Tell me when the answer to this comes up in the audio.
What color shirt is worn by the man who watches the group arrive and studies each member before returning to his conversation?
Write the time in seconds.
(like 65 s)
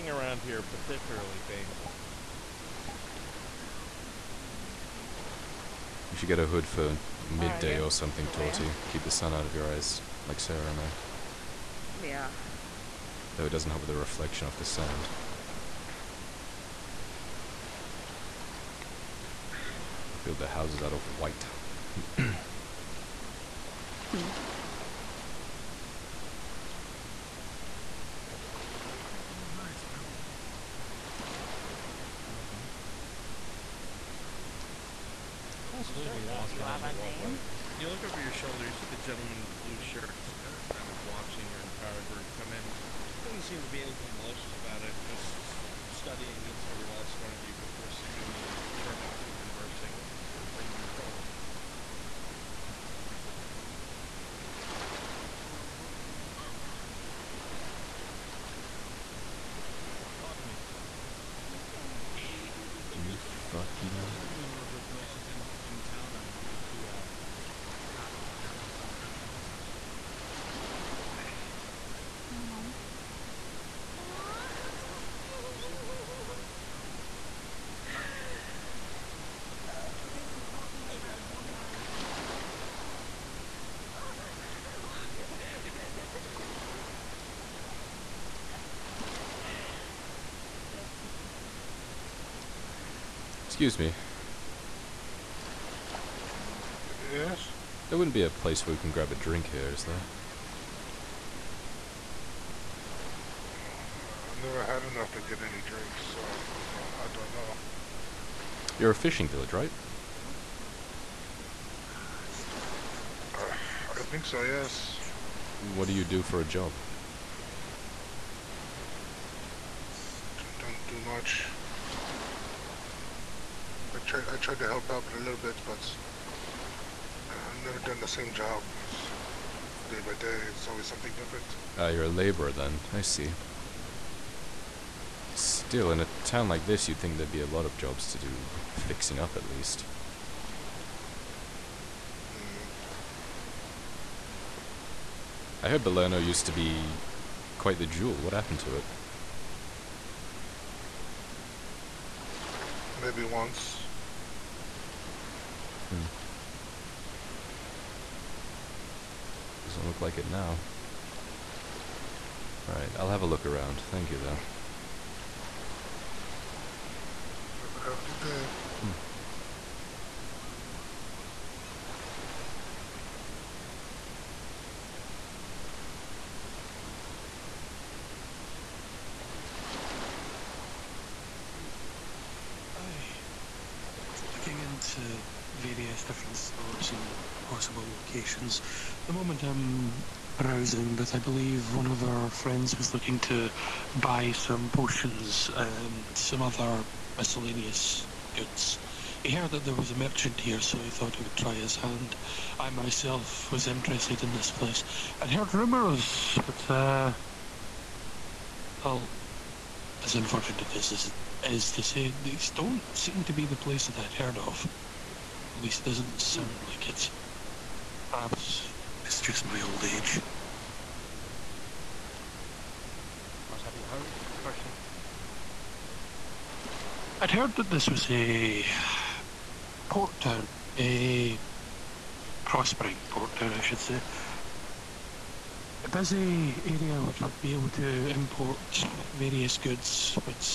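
39 s.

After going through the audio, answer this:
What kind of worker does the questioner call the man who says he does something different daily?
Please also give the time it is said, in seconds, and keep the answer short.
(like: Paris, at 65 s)
Laborer, at 132 s.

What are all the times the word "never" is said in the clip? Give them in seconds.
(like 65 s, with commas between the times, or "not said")
104 s, 127 s.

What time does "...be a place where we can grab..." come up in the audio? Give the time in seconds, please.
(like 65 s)
98 s.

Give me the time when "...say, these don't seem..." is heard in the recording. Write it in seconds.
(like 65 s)
211 s.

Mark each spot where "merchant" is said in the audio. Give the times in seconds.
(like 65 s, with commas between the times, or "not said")
64 s, 199 s.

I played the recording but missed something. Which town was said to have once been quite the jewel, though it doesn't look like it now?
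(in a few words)
Belerno.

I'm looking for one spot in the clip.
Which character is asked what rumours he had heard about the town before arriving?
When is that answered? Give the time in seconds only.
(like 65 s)
224 s.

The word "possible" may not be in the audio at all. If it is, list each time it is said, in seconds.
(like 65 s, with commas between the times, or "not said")
187 s.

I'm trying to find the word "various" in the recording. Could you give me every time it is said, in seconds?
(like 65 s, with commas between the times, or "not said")
185 s, 239 s.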